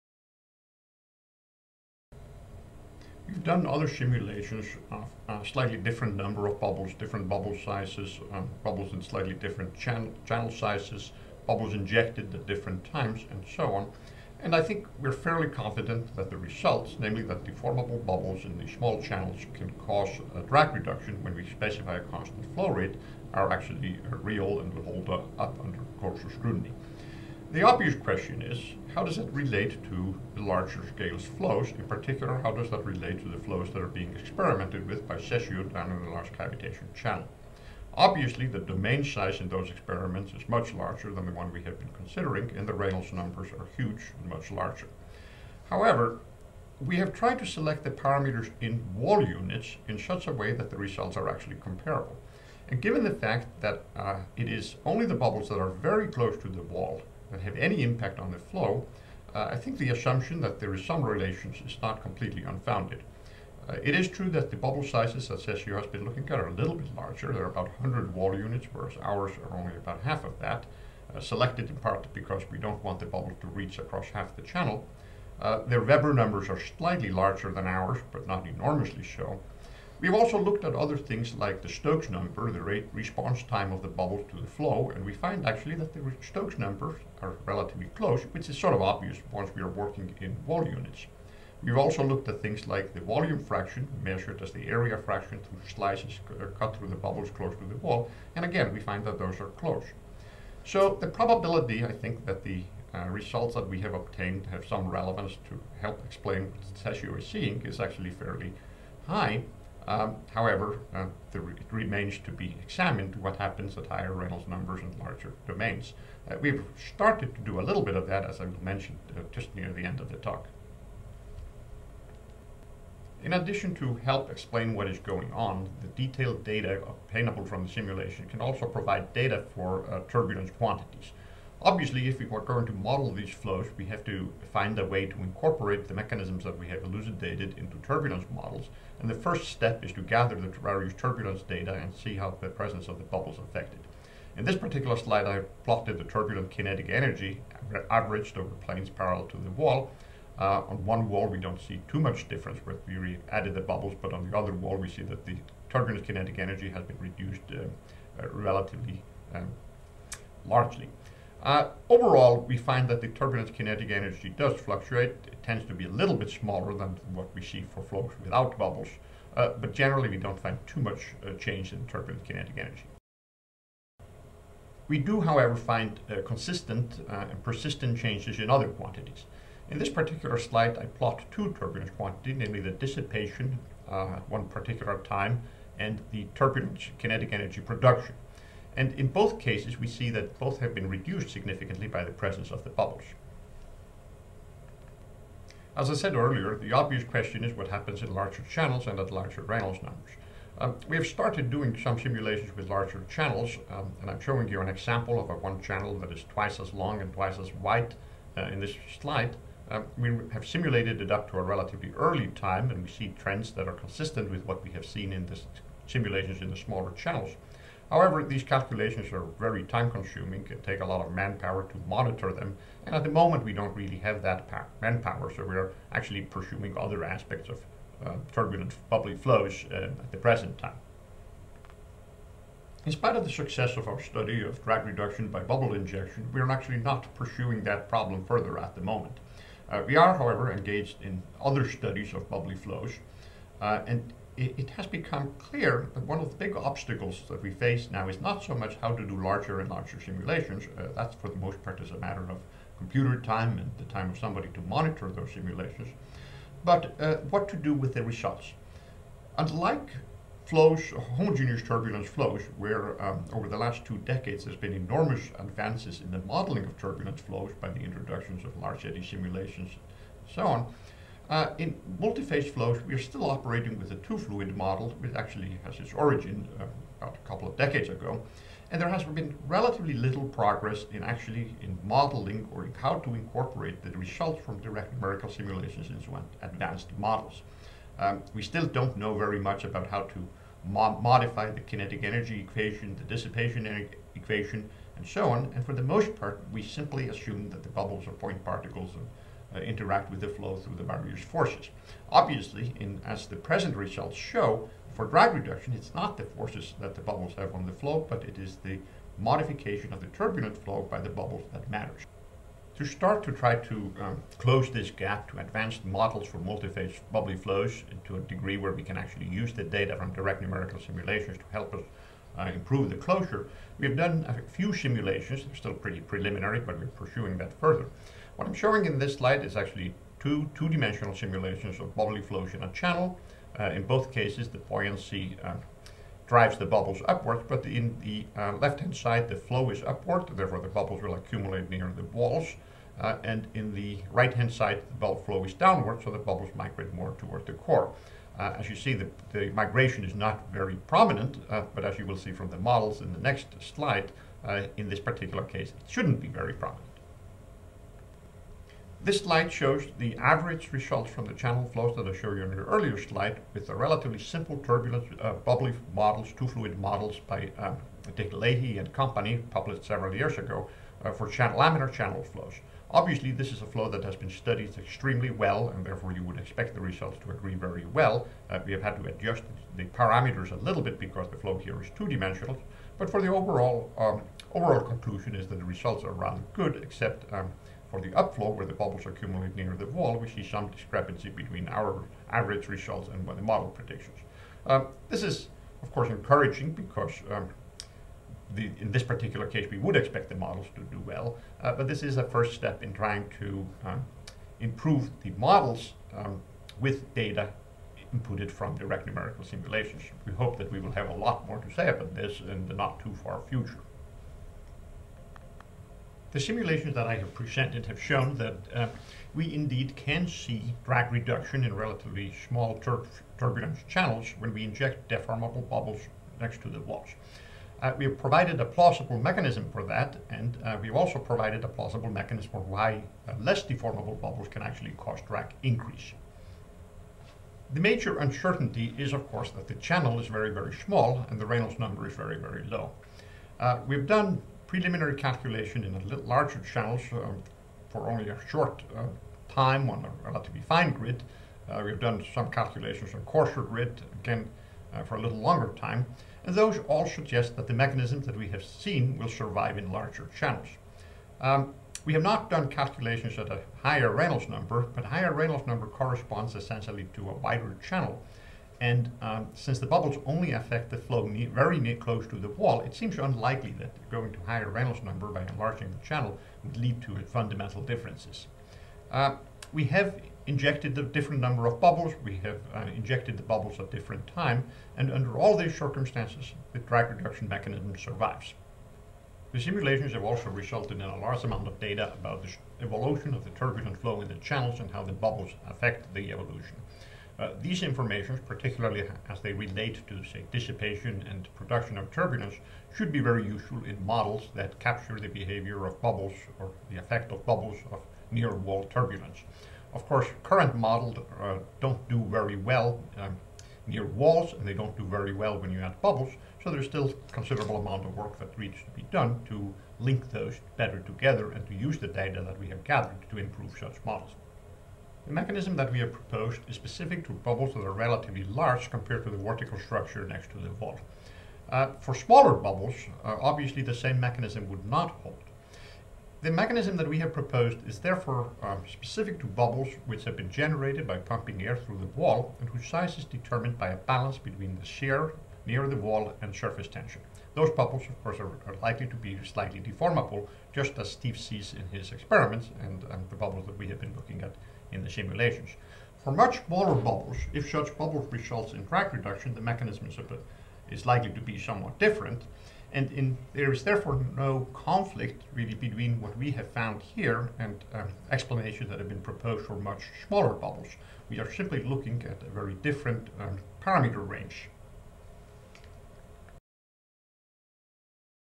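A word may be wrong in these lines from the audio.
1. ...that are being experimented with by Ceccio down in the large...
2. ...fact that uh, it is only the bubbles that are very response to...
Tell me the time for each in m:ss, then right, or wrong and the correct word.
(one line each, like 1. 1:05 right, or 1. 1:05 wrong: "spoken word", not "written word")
1. 0:33 right
2. 0:53 wrong: "close", not "response".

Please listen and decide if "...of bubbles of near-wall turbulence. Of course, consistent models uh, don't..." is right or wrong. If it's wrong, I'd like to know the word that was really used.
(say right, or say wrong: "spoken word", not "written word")
wrong: "current", not "consistent".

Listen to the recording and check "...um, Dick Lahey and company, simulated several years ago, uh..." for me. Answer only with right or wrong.
wrong.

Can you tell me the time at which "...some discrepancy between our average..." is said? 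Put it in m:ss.
6:30.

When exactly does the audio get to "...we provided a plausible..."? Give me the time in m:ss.
7:07.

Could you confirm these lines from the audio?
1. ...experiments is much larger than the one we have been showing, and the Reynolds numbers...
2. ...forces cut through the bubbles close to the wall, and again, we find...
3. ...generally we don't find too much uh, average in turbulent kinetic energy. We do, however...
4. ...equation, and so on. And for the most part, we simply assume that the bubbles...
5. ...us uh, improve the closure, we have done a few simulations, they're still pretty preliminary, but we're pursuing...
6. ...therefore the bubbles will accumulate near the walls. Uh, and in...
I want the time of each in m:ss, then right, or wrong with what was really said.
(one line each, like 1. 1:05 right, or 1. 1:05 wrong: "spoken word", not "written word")
1. 0:39 wrong: "considering", not "showing"
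2. 1:35 wrong: "slices", not "forces"
3. 2:49 wrong: "change", not "average"
4. 4:54 right
5. 5:21 right
6. 5:40 right.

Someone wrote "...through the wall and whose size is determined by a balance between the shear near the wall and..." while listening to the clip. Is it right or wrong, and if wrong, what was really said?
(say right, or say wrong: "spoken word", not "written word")
right.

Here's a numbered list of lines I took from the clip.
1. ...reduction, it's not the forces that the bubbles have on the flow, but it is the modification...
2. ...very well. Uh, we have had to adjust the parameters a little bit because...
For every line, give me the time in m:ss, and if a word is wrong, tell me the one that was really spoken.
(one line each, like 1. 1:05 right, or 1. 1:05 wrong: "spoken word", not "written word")
1. 5:05 right
2. 6:17 right.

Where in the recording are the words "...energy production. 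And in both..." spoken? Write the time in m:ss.
3:07.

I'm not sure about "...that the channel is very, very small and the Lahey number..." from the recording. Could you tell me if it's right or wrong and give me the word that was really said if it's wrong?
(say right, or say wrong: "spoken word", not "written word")
wrong: "Reynolds", not "Lahey".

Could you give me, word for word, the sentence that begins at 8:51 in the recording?
Uh, for smaller bubbles, uh, obviously the same mechanism would not hold.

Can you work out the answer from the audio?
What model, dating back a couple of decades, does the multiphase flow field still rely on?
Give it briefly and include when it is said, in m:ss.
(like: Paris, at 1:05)
two-fluid model, at 4:34.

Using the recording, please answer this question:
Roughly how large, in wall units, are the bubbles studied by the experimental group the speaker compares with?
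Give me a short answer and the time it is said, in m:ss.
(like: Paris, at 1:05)
100 wall units, at 1:07.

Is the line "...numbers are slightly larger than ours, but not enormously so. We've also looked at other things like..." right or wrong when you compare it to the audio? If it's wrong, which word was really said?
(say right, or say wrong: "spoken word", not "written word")
right.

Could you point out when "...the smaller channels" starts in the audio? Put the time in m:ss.
3:36.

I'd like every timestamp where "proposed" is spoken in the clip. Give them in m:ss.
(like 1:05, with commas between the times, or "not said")
8:46, 8:57, 9:29.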